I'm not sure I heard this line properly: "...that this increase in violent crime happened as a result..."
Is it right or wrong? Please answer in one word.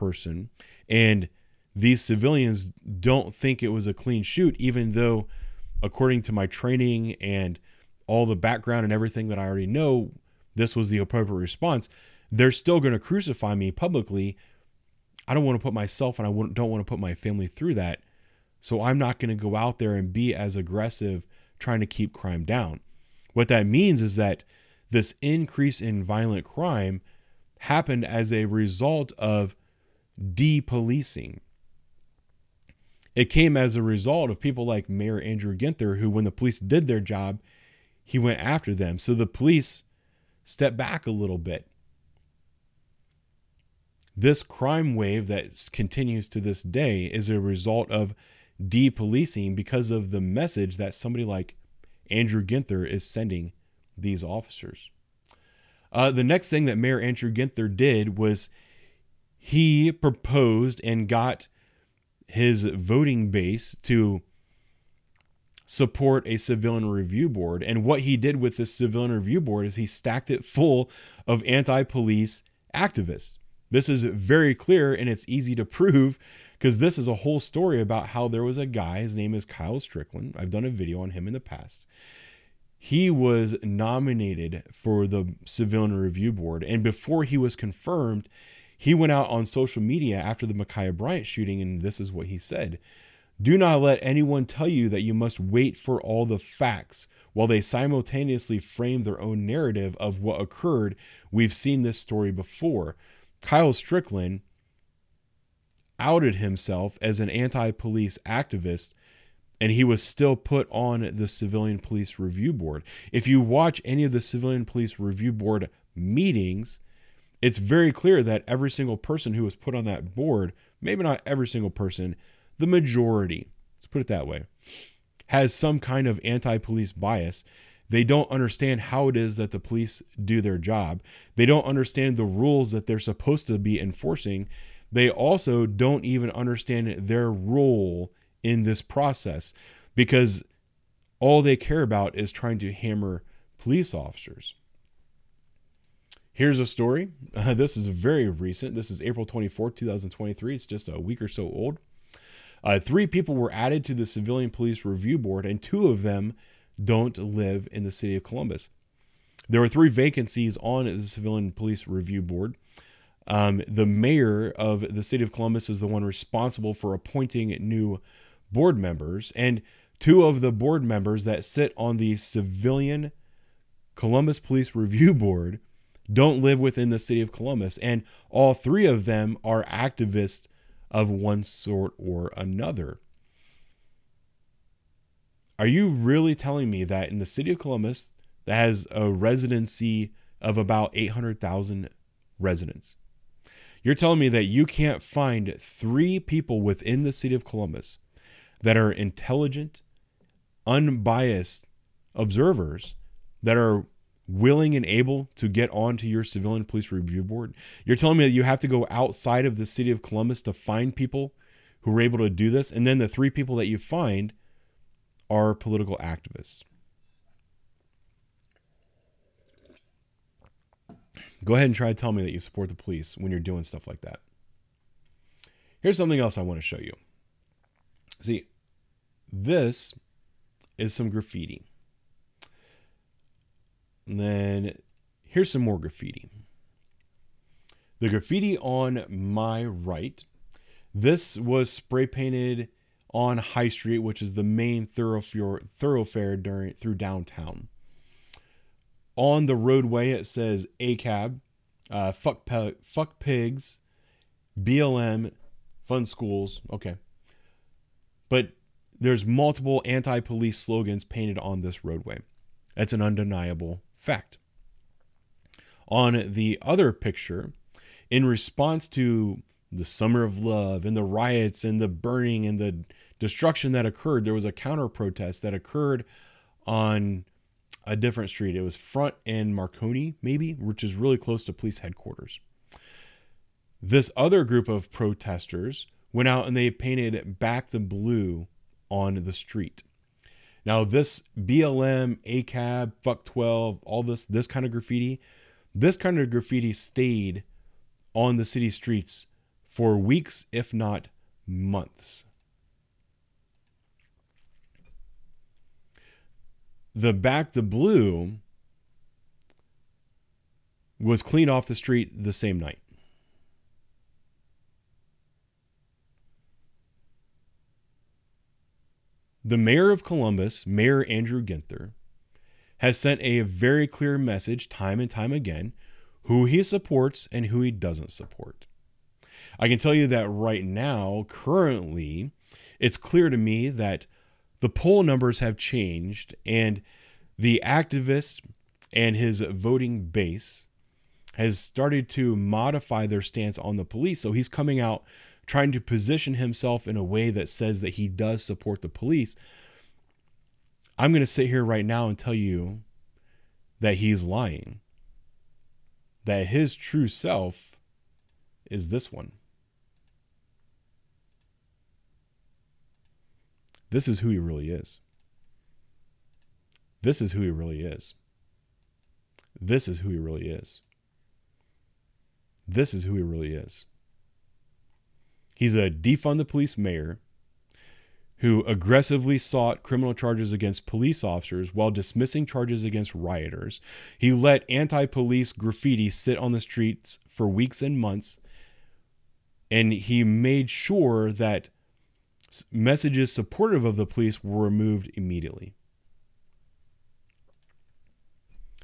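right.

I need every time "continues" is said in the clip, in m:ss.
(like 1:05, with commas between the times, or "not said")
0:45.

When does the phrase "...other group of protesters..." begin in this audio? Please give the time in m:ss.
4:44.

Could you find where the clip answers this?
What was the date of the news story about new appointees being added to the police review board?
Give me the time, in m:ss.
2:29.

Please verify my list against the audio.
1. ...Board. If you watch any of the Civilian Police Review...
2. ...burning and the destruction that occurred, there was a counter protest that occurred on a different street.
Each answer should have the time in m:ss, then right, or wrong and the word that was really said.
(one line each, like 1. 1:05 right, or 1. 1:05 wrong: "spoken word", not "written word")
1. 1:52 right
2. 4:31 right.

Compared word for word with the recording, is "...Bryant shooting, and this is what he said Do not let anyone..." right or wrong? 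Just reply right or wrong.
right.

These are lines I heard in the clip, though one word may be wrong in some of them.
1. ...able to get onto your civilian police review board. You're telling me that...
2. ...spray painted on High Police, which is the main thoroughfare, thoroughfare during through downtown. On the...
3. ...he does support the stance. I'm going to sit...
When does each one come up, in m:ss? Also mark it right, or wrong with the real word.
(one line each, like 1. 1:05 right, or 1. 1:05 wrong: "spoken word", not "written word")
1. 3:24 right
2. 4:01 wrong: "Street", not "Police"
3. 5:47 wrong: "police", not "stance".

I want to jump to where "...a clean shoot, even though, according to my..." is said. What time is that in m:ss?
0:03.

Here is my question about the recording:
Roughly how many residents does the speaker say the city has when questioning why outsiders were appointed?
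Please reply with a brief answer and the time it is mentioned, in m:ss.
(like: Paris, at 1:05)
800,000, at 3:10.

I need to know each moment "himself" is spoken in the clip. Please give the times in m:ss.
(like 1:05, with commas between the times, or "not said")
1:46, 5:46.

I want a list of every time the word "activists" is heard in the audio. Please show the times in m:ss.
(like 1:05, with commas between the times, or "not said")
1:12, 1:48, 2:59, 3:35, 5:37.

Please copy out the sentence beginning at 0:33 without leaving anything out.
It came as a result of people like Mayor Andrew Ginther, who, when the police did their job, he went after them.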